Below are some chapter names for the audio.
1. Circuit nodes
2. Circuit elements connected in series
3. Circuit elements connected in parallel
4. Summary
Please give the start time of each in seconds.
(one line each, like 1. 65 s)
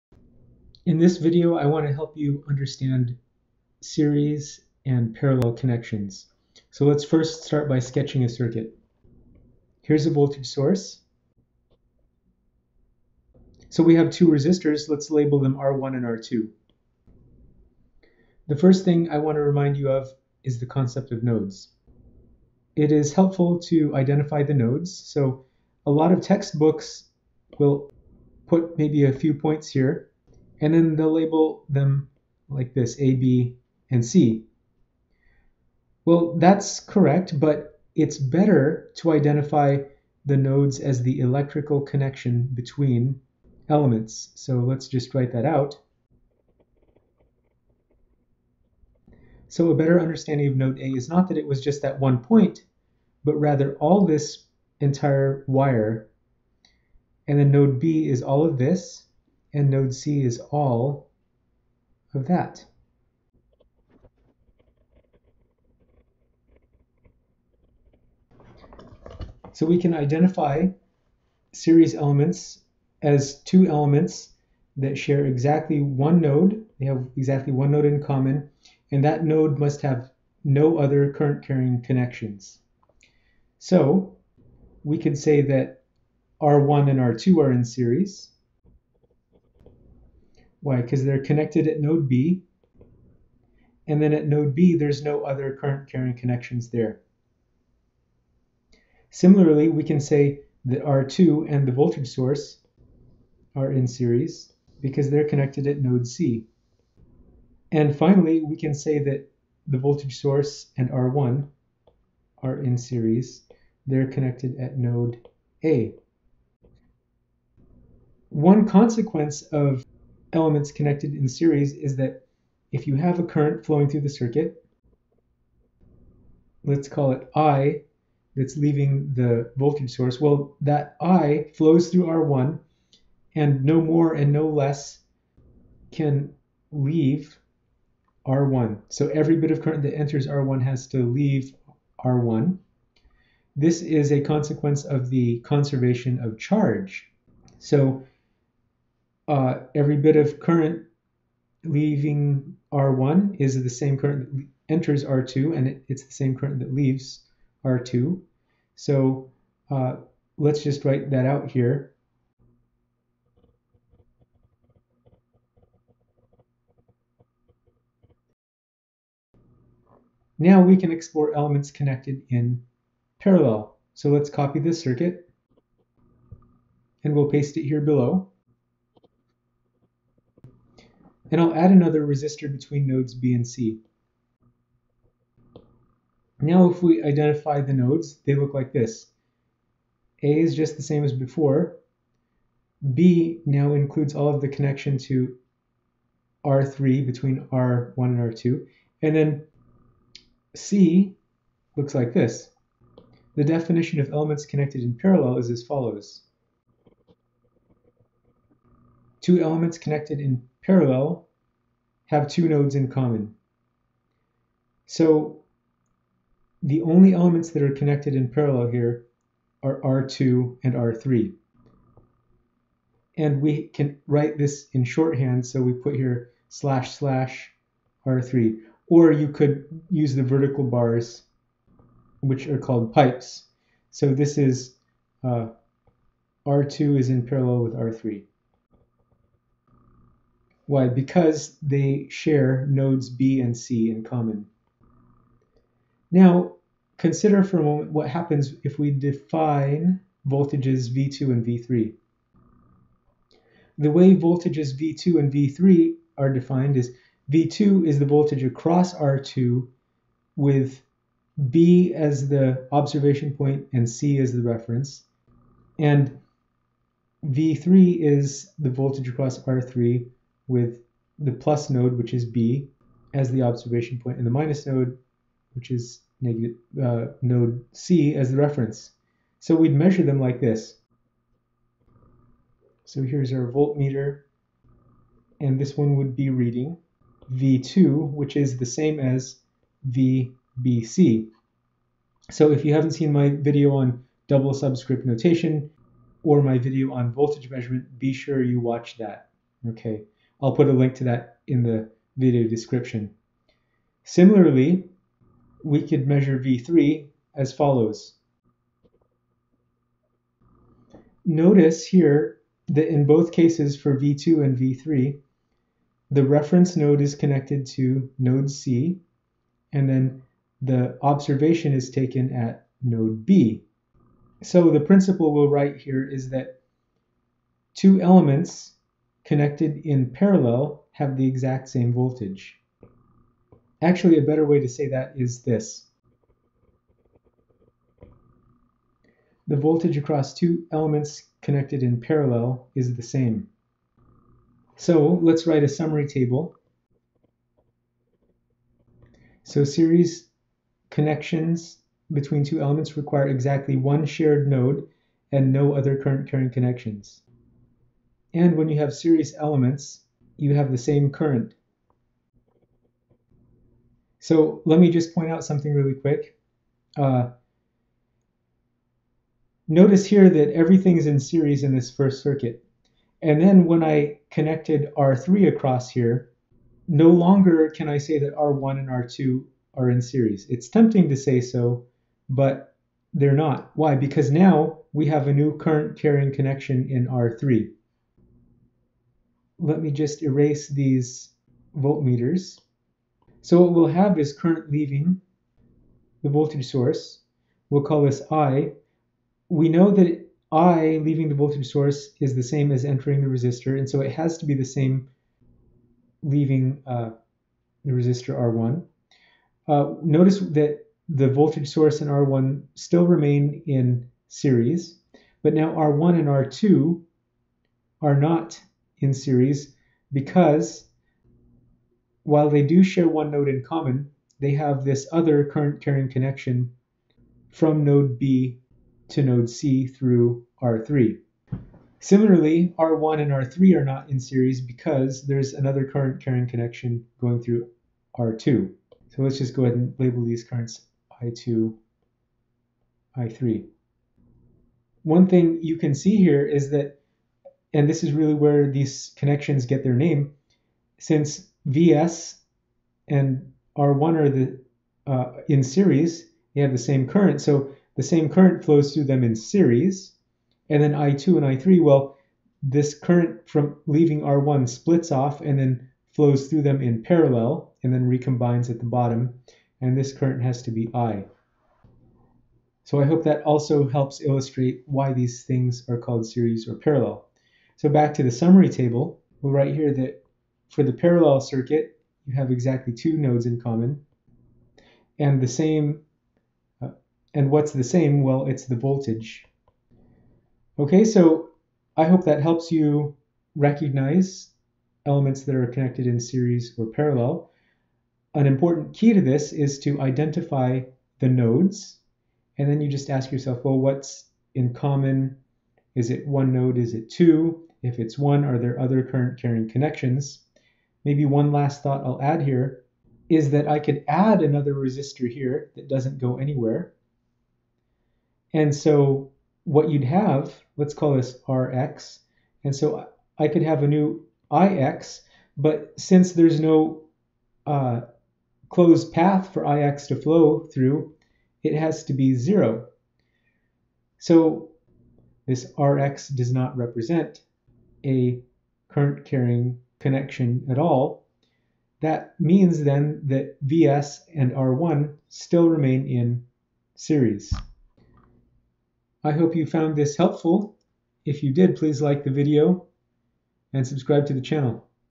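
1. 18 s
2. 62 s
3. 169 s
4. 343 s.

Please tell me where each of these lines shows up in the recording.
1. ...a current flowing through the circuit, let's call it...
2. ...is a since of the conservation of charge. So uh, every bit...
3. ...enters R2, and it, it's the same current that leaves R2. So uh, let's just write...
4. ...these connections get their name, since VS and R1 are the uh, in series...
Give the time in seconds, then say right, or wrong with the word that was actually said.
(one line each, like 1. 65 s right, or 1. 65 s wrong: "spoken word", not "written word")
1. 123 s right
2. 143 s wrong: "consequence", not "since"
3. 154 s right
4. 448 s right.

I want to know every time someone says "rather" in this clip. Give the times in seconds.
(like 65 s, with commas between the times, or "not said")
53 s.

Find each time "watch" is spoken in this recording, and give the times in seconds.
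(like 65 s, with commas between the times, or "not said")
298 s.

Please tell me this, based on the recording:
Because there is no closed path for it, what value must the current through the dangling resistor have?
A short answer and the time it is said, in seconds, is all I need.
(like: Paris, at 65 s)
0, at 532 s.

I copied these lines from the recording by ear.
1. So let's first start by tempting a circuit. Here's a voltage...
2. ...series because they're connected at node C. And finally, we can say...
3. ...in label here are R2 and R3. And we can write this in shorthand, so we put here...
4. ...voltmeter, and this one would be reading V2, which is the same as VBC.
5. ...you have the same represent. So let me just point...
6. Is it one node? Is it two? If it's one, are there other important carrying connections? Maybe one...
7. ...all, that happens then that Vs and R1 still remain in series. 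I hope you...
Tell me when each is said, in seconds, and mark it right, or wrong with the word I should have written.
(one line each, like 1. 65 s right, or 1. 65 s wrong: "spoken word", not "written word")
1. 6 s wrong: "sketching", not "tempting"
2. 103 s right
3. 218 s wrong: "parallel", not "label"
4. 283 s right
5. 360 s wrong: "current", not "represent"
6. 505 s wrong: "current", not "important"
7. 540 s wrong: "means", not "happens".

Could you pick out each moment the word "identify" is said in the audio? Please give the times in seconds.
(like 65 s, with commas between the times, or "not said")
23 s, 39 s, 69 s, 187 s, 500 s.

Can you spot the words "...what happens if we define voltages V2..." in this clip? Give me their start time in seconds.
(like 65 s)
247 s.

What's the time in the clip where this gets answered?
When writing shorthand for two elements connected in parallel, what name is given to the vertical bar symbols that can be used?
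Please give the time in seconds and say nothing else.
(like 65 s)
232 s.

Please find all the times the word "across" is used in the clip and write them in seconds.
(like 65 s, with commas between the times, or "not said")
258 s, 269 s, 339 s, 375 s.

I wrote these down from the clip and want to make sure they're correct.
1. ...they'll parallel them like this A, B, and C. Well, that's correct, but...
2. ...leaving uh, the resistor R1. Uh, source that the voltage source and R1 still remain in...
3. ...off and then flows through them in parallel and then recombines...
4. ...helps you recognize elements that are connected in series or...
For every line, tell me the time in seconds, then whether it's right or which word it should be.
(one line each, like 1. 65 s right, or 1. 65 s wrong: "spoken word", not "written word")
1. 30 s wrong: "label", not "parallel"
2. 406 s wrong: "notice", not "source"
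3. 465 s right
4. 492 s right.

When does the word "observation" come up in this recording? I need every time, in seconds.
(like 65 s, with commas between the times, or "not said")
262 s, 273 s, 321 s.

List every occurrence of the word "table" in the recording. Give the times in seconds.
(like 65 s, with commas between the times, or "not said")
346 s, 478 s.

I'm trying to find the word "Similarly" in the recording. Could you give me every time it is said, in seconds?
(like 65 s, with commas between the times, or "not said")
99 s, 304 s, 431 s.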